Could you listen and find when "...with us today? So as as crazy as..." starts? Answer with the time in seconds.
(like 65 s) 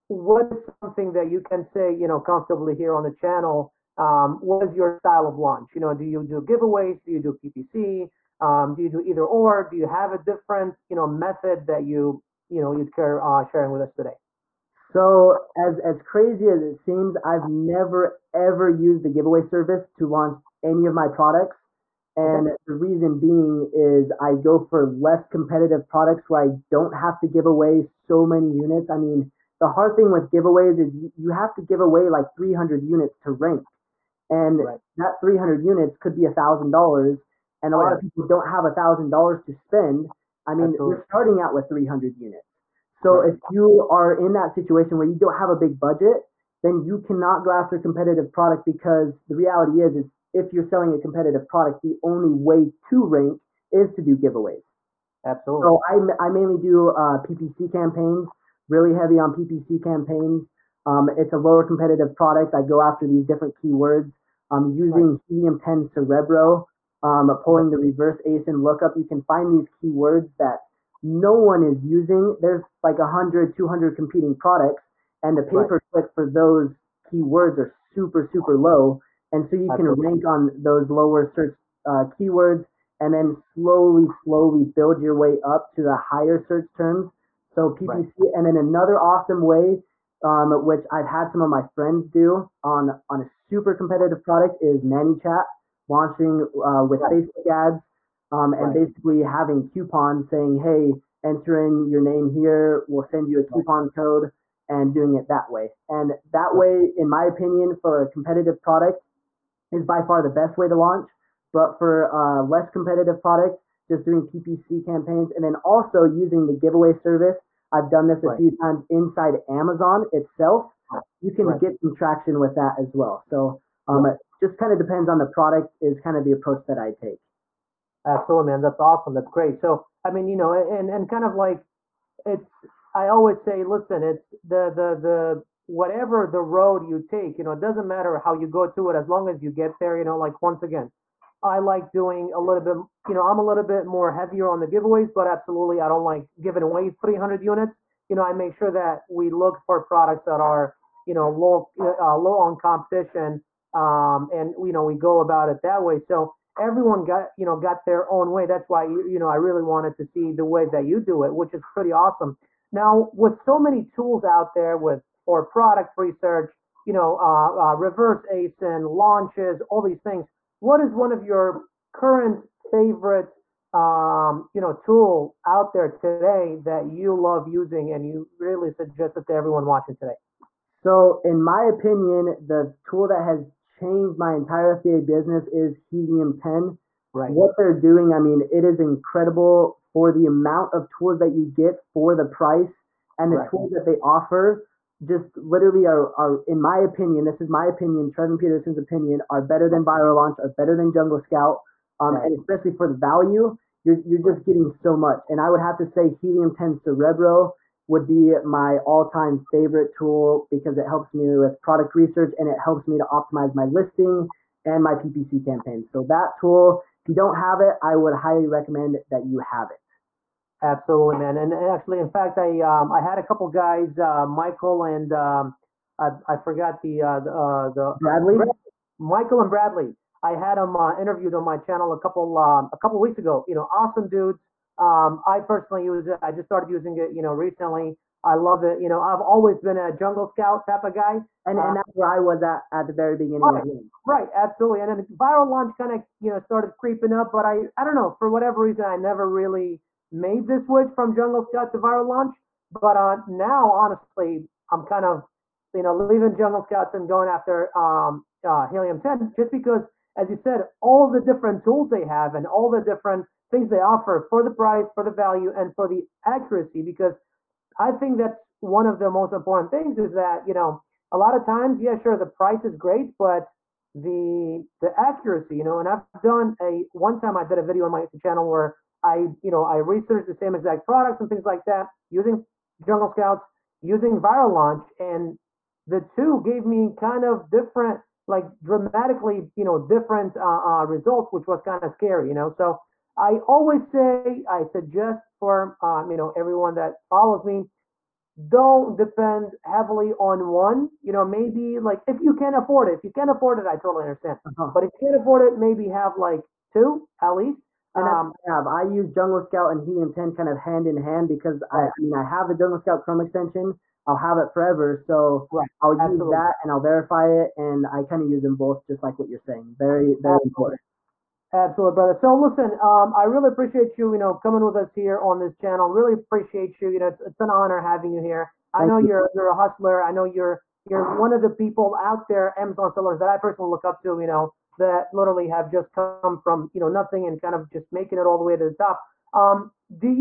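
13 s.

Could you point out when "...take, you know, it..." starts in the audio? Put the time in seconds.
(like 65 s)
137 s.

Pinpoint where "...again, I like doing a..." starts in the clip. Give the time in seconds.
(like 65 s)
140 s.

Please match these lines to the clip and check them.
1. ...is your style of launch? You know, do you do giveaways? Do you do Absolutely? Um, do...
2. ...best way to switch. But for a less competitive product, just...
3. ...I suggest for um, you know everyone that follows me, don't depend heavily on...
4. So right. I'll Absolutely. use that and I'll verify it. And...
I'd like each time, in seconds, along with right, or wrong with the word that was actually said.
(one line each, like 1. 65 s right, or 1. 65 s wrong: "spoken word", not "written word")
1. 4 s wrong: "PPC", not "Absolutely"
2. 110 s wrong: "launch", not "switch"
3. 294 s right
4. 314 s right.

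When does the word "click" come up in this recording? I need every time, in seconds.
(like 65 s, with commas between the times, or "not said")
75 s.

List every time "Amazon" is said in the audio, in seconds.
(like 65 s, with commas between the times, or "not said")
119 s, 332 s.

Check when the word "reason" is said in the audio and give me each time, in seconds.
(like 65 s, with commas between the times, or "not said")
22 s, 248 s.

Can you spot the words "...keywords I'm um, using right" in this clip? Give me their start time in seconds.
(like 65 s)
63 s.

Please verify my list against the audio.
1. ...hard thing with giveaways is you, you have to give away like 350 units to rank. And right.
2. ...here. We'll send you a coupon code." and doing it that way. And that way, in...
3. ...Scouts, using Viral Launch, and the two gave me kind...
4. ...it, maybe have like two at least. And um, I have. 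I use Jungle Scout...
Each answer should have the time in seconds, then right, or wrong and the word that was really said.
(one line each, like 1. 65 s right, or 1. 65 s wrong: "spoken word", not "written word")
1. 29 s wrong: "300", not "350"
2. 102 s right
3. 283 s right
4. 305 s right.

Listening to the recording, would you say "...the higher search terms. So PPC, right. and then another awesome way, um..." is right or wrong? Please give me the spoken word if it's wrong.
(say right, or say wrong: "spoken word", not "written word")
right.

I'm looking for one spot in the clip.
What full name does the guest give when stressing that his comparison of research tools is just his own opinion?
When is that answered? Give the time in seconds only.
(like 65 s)
198 s.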